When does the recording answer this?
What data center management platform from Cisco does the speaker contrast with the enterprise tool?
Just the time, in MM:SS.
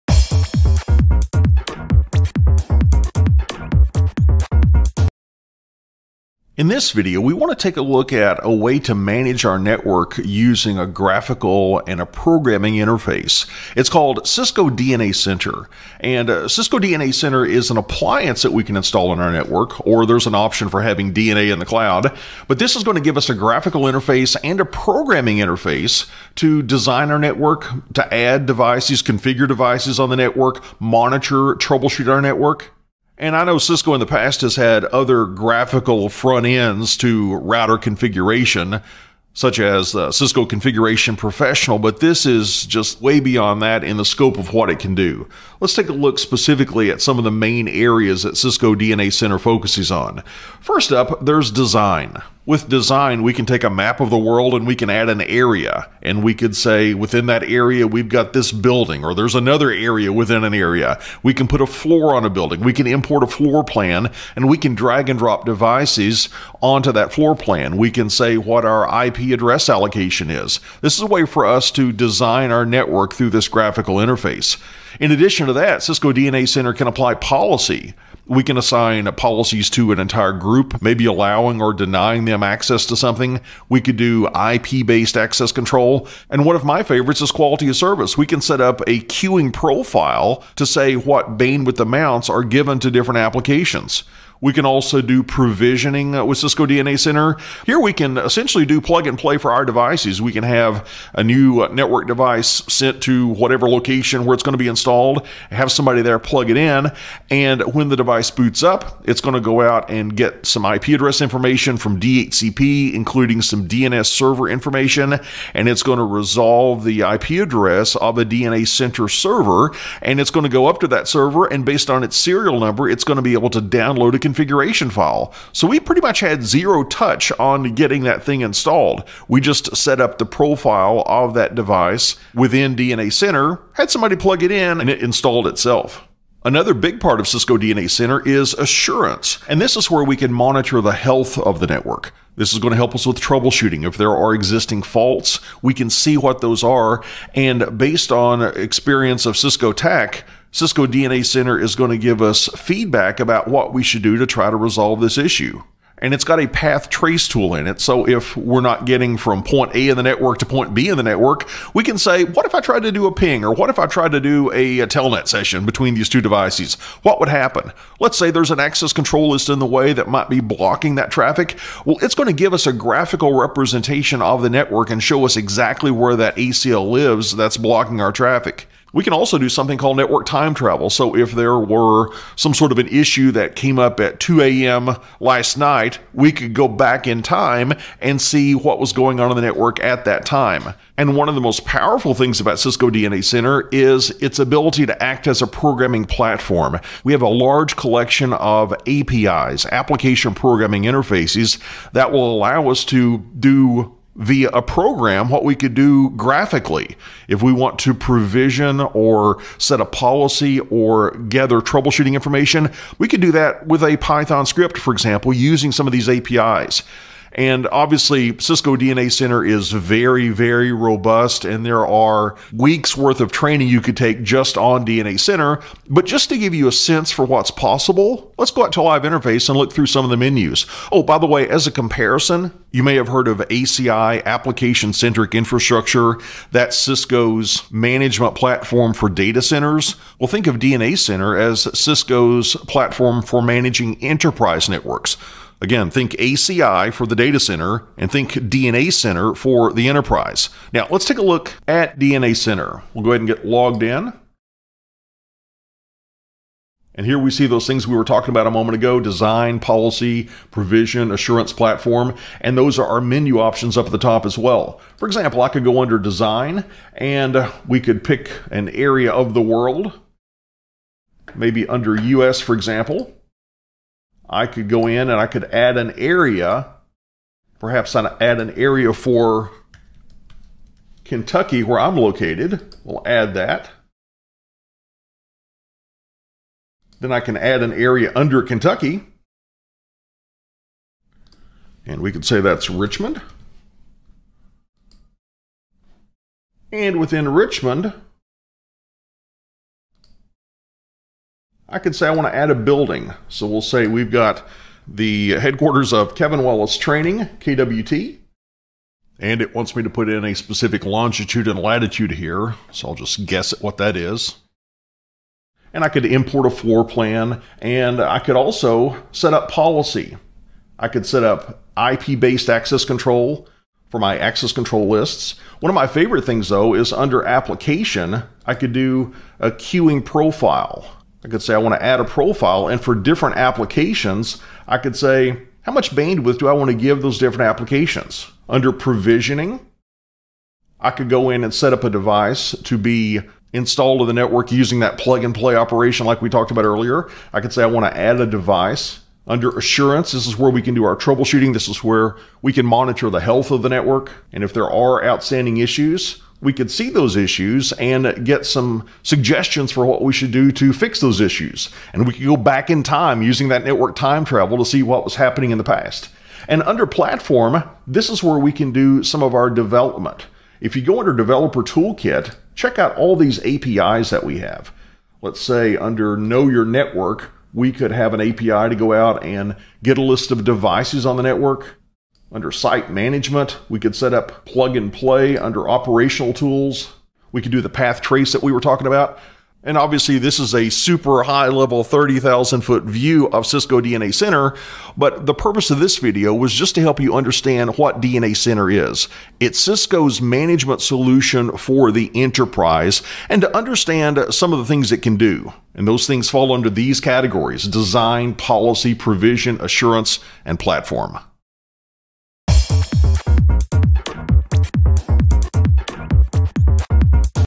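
03:54.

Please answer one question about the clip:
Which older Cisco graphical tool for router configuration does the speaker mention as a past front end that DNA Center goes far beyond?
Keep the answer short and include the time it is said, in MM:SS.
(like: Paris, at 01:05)
Cisco Configuration Professional, at 00:40.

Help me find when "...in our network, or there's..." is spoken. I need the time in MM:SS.
00:19.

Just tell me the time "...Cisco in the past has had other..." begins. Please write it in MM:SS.
00:33.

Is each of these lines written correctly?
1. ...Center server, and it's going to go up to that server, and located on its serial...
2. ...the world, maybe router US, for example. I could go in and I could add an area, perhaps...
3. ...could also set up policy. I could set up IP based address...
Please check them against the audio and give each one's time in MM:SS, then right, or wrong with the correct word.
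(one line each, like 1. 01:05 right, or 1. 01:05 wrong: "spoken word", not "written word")
1. 01:58 wrong: "based", not "located"
2. 04:29 wrong: "under", not "router"
3. 05:18 wrong: "access", not "address".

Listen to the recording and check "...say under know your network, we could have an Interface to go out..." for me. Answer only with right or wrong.
wrong.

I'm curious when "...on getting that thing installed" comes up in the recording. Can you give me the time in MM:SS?
02:07.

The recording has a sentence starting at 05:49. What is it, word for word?
Under assurance, this is where we can do our troubleshooting.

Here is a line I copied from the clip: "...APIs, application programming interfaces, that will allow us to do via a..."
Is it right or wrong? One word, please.
right.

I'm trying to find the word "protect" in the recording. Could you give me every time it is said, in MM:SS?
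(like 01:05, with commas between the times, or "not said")
not said.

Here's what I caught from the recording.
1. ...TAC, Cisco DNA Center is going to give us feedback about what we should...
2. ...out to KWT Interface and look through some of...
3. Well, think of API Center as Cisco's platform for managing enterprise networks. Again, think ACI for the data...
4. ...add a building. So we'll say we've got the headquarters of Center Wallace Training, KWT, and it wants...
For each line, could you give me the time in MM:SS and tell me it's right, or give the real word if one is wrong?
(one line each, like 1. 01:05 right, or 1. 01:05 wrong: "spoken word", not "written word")
1. 02:29 right
2. 03:48 wrong: "Live", not "KWT"
3. 04:00 wrong: "DNA", not "API"
4. 05:02 wrong: "Kevin", not "Center".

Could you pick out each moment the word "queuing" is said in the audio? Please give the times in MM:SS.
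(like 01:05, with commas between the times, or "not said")
01:29, 05:29.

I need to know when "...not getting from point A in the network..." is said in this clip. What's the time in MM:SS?
02:38.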